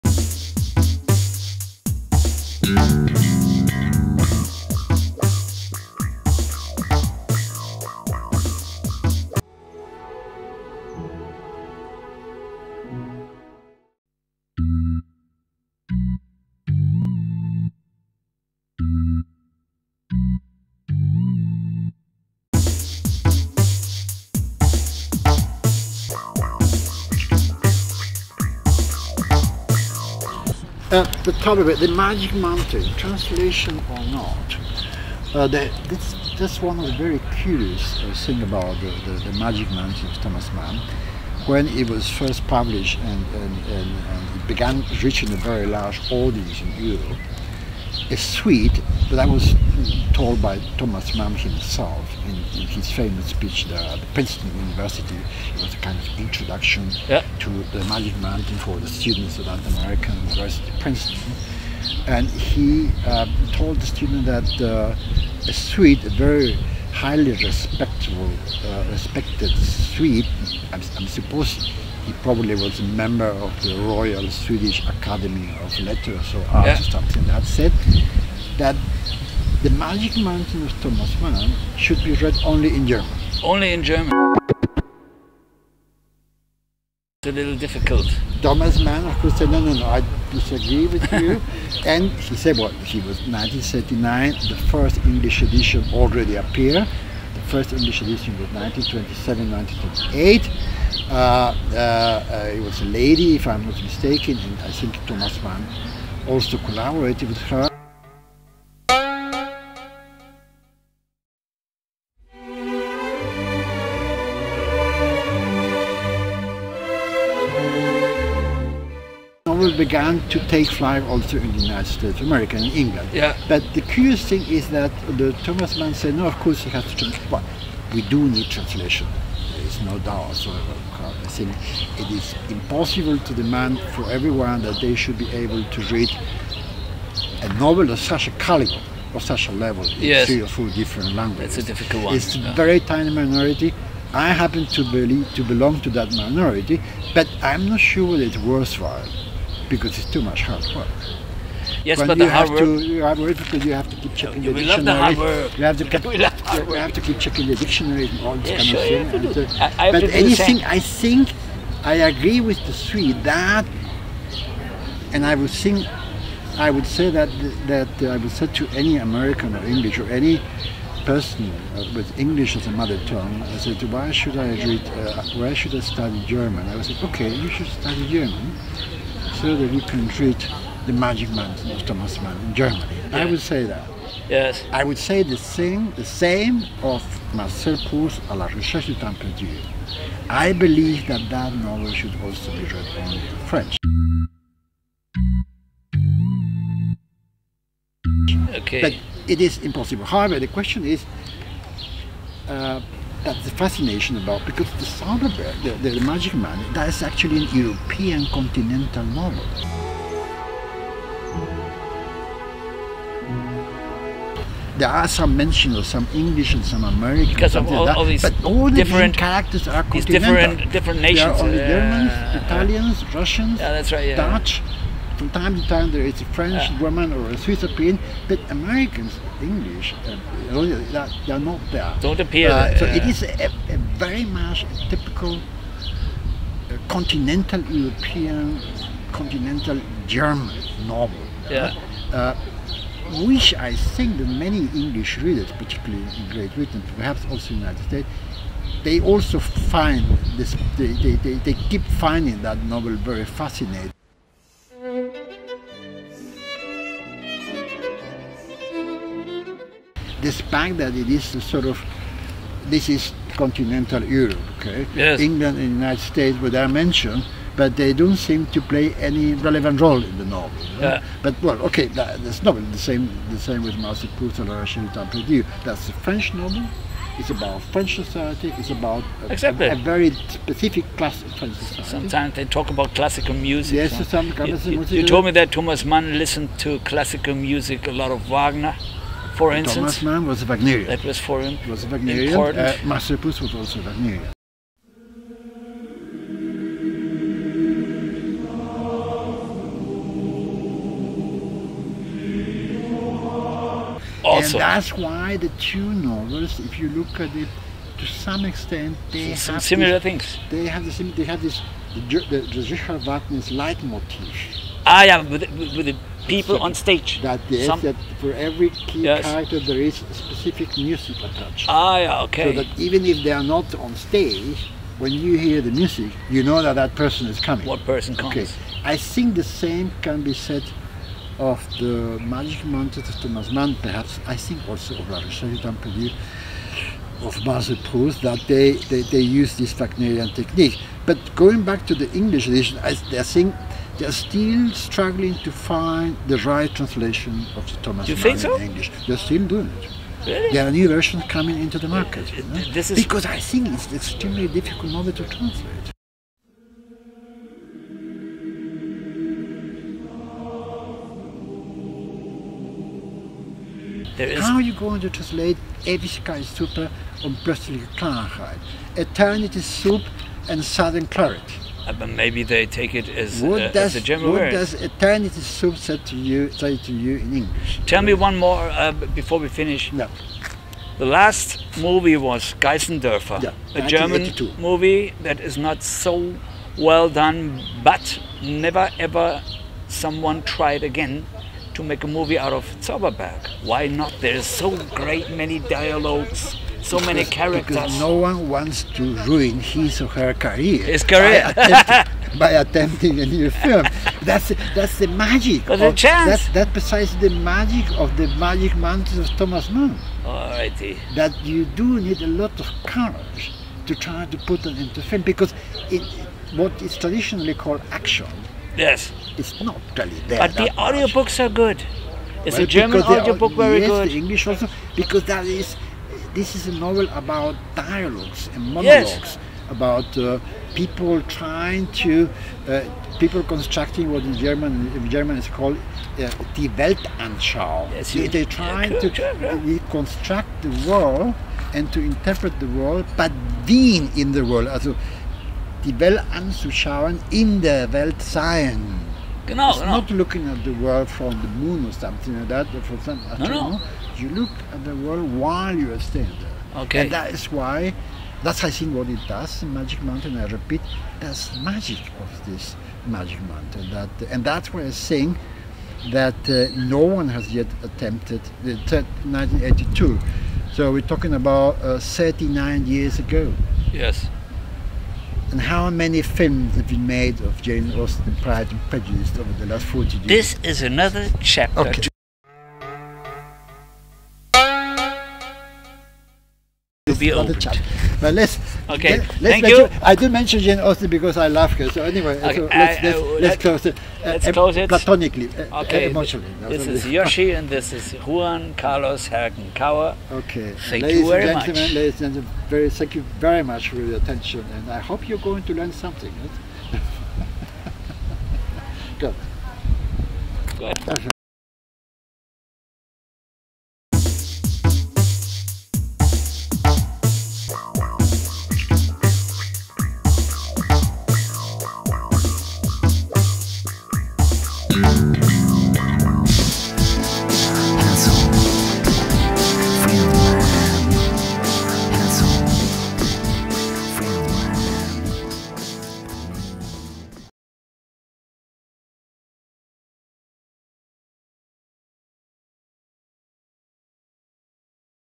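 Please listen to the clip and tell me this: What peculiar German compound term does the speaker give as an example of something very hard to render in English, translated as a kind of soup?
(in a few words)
Ewigkeitssuppe.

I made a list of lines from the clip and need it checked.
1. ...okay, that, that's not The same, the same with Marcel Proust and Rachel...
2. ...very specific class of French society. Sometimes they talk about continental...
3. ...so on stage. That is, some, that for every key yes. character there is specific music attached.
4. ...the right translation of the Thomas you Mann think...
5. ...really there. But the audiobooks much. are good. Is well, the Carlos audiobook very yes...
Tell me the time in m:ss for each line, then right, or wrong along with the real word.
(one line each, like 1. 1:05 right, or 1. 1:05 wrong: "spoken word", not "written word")
1. 4:31 right
2. 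4:39 wrong: "classical", not "continental"
3. 5:16 right
4. 5:46 right
5. 6:59 wrong: "German", not "Carlos".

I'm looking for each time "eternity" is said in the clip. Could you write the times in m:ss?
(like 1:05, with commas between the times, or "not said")
6:08, 6:14.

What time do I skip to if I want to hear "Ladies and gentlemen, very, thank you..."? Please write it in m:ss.
8:21.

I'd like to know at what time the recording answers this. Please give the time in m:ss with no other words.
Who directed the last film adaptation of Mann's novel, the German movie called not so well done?
6:22.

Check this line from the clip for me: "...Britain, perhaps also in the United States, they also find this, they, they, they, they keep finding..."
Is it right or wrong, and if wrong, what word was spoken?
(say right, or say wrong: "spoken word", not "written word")
right.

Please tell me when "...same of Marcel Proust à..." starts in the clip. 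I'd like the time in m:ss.
3:06.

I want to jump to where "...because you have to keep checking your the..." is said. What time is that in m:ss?
2:33.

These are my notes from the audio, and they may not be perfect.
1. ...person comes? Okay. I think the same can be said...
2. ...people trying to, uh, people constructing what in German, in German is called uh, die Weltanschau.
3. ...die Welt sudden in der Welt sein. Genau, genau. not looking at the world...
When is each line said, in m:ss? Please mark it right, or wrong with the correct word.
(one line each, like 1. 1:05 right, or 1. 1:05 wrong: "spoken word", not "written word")
1. 5:27 right
2. 7:10 right
3. 7:25 wrong: "anzuschauen", not "sudden".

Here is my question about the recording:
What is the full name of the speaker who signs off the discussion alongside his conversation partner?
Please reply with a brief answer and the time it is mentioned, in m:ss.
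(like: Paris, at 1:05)
Juan Carlos Herken Krauer, at 8:18.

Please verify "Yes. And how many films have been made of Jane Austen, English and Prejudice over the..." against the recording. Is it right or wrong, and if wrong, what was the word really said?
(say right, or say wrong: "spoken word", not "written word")
wrong: "Pride", not "English".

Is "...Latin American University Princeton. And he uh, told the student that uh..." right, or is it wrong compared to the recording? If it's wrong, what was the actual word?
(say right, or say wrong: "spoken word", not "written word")
right.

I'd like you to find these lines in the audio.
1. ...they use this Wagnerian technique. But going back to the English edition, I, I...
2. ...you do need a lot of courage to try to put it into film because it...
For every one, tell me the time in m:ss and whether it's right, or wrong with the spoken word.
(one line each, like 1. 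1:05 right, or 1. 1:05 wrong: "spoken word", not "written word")
1. 5:39 right
2. 6:51 right.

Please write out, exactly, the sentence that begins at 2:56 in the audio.
I said, okay, you should study German so that you can read The Magic man, of Thomas Mann in Germany.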